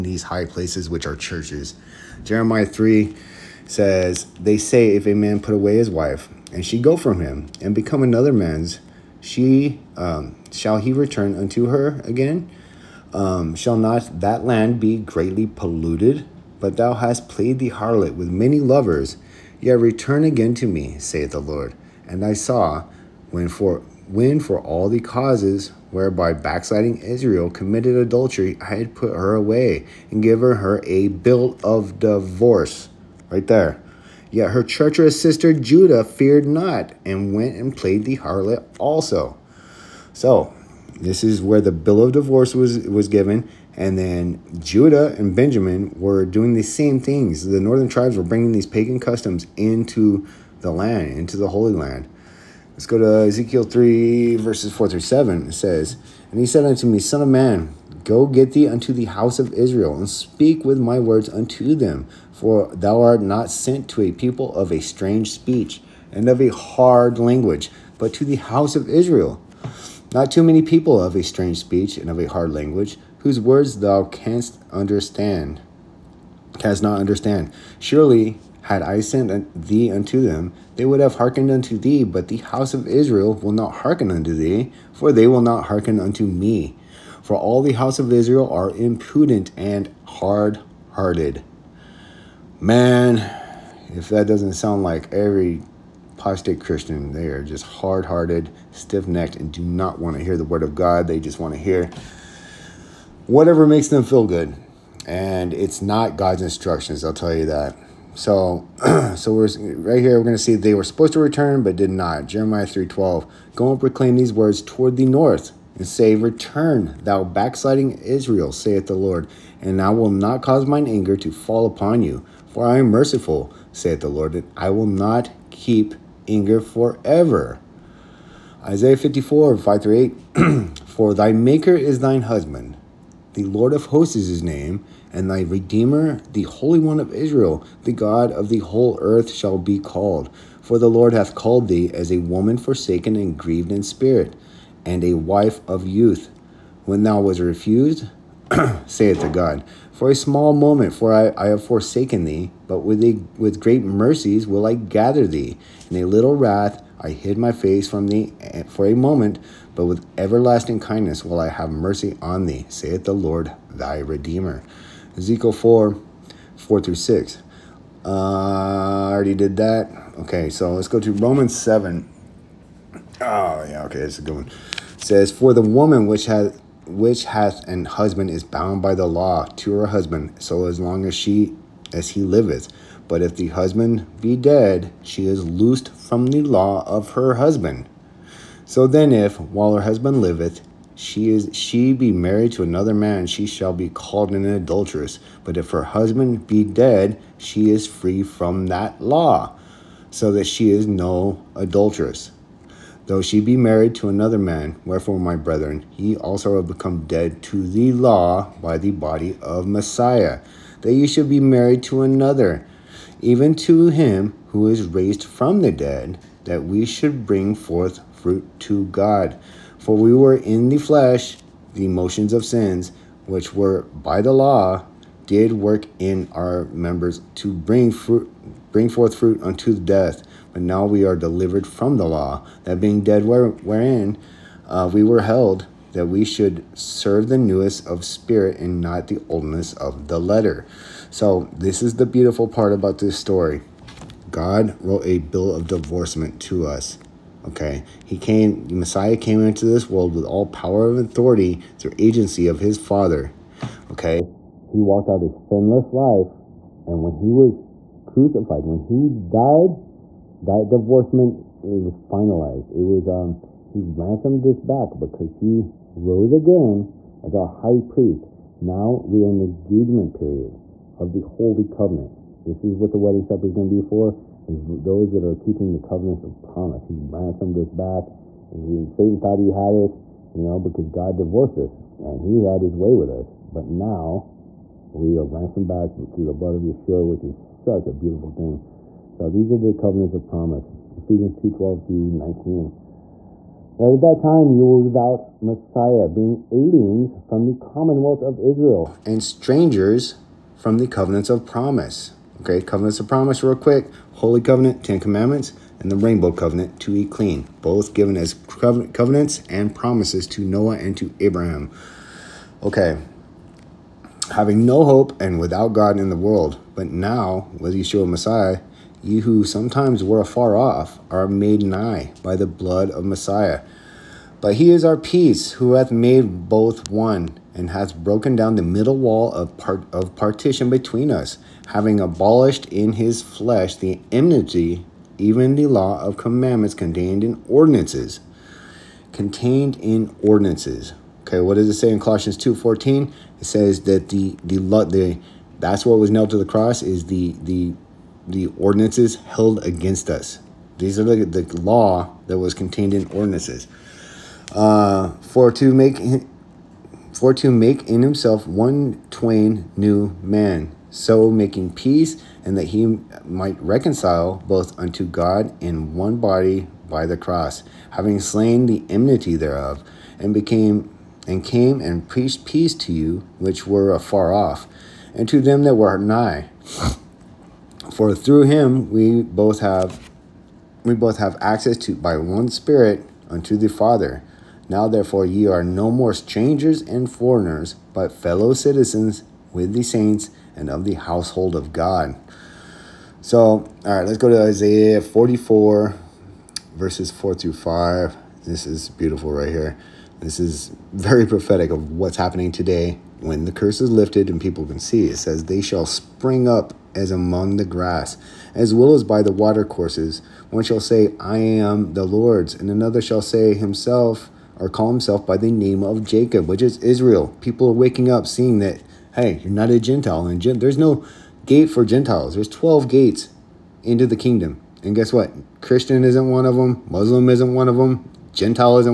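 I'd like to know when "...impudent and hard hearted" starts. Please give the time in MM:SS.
01:28.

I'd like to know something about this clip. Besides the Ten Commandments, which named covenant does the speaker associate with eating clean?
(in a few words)
Rainbow Covenant.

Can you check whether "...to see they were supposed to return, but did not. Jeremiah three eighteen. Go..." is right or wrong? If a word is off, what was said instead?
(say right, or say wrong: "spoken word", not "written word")
wrong: "twelve", not "eighteen".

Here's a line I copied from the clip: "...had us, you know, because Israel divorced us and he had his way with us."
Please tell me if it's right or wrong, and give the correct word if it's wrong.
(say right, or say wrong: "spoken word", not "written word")
wrong: "God", not "Israel".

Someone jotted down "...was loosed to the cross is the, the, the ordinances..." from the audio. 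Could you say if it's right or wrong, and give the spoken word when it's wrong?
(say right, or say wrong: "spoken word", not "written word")
wrong: "nailed", not "loosed".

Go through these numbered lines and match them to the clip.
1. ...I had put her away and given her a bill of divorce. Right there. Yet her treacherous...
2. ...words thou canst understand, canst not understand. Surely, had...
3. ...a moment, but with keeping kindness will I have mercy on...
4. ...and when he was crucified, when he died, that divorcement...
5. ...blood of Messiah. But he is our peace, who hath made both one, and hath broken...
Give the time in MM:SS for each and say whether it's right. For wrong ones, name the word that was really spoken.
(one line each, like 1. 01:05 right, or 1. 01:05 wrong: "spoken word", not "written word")
1. 00:28 right
2. 01:13 right
3. 02:38 wrong: "everlasting", not "keeping"
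4. 04:16 right
5. 05:22 right.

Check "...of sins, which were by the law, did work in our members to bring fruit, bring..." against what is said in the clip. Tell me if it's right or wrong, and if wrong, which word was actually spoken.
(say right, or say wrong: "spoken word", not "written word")
right.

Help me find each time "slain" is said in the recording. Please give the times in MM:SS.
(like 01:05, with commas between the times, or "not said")
06:08.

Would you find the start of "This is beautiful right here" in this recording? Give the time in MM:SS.
06:38.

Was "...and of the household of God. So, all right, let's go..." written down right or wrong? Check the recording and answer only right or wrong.
right.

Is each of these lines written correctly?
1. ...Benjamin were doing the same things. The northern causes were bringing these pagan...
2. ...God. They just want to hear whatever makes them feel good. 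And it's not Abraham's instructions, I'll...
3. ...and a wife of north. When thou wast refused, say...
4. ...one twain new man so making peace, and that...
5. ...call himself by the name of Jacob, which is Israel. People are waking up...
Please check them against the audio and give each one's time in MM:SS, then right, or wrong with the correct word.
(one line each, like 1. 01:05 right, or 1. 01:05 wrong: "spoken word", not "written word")
1. 00:45 wrong: "tribes", not "causes"
2. 01:40 wrong: "God", not "Abraham"
3. 02:24 wrong: "youth", not "north"
4. 05:58 right
5. 06:54 right.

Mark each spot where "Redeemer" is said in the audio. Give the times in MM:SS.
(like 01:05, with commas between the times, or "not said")
02:15, 02:43.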